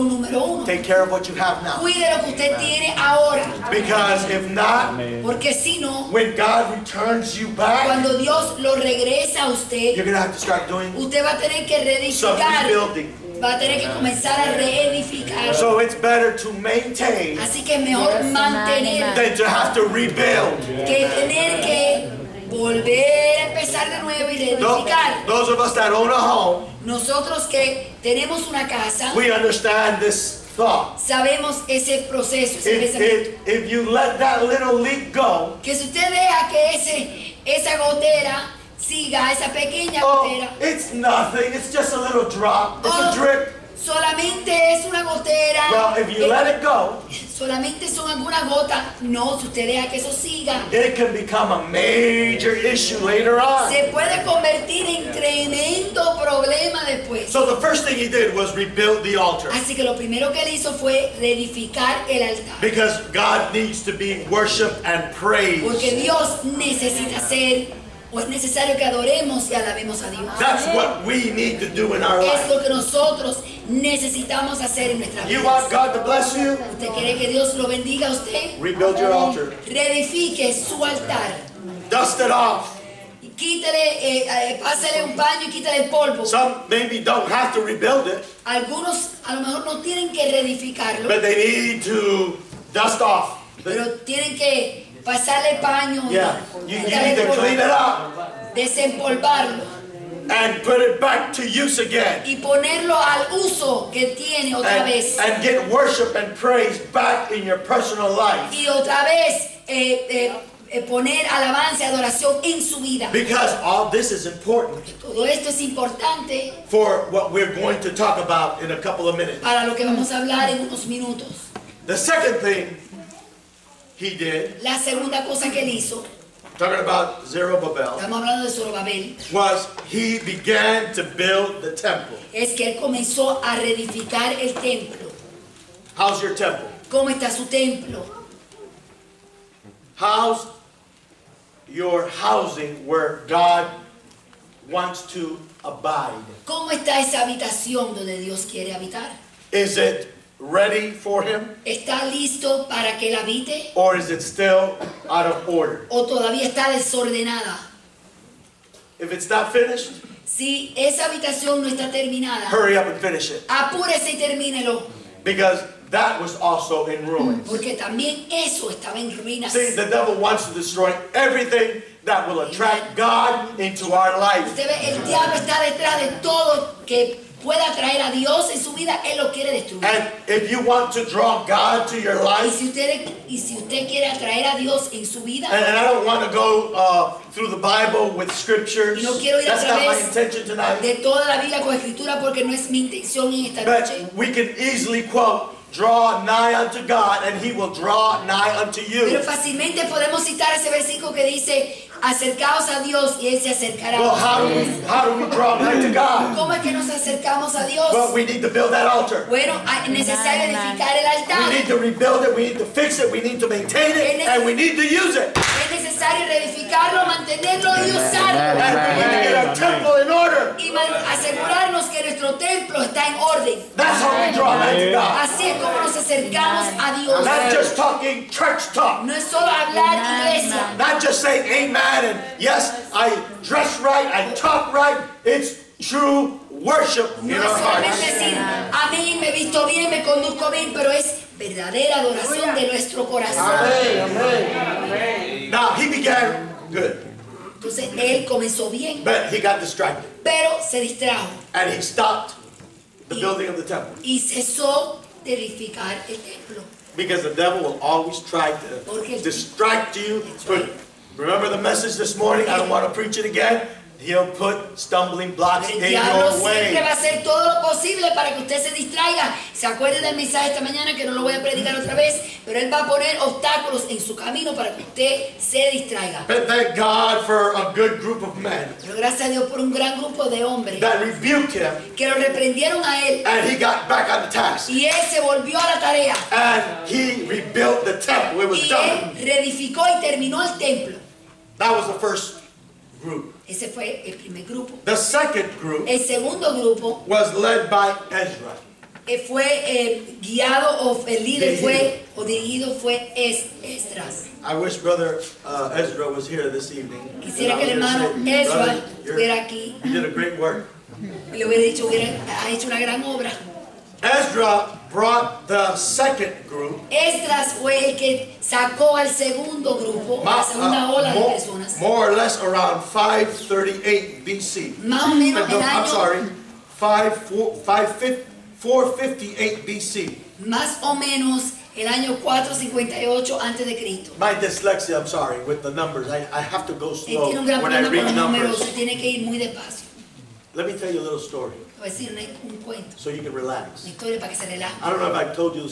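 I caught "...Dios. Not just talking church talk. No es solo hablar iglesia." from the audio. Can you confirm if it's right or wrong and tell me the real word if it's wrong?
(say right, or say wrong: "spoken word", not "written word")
right.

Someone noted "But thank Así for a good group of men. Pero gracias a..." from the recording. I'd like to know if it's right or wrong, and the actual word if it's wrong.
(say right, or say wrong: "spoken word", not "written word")
wrong: "God", not "Así".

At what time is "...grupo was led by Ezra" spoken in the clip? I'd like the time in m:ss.
4:56.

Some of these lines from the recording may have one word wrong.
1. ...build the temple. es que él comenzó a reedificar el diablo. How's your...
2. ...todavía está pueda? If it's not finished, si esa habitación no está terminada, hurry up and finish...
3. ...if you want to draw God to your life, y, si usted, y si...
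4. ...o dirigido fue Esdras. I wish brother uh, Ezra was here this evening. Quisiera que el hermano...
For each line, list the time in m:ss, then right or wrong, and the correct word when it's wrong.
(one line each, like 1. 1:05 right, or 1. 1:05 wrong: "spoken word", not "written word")
1. 2:11 wrong: "templo", not "diablo"
2. 2:36 wrong: "desordenada", not "pueda"
3. 3:00 right
4. 5:02 right.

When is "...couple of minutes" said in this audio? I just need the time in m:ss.
1:58.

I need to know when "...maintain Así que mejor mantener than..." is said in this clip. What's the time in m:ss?
0:16.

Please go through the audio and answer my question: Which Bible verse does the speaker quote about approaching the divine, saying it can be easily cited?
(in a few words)
Draw nigh unto God.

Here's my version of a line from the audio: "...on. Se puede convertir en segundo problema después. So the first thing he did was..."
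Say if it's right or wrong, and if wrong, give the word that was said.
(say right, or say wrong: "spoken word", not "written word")
wrong: "tremendo", not "segundo".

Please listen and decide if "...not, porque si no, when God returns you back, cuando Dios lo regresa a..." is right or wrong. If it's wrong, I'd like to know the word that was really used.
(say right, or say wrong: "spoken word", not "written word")
right.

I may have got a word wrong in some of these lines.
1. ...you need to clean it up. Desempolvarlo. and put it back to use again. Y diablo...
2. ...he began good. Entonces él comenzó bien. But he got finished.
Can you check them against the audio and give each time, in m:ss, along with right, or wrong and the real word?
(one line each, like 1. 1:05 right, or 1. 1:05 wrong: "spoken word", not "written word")
1. 1:36 wrong: "ponerlo", not "diablo"
2. 4:05 wrong: "distracted", not "finished".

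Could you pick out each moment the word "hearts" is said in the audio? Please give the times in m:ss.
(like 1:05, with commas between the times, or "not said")
3:57.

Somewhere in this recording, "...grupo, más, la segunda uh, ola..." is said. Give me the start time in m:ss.
5:19.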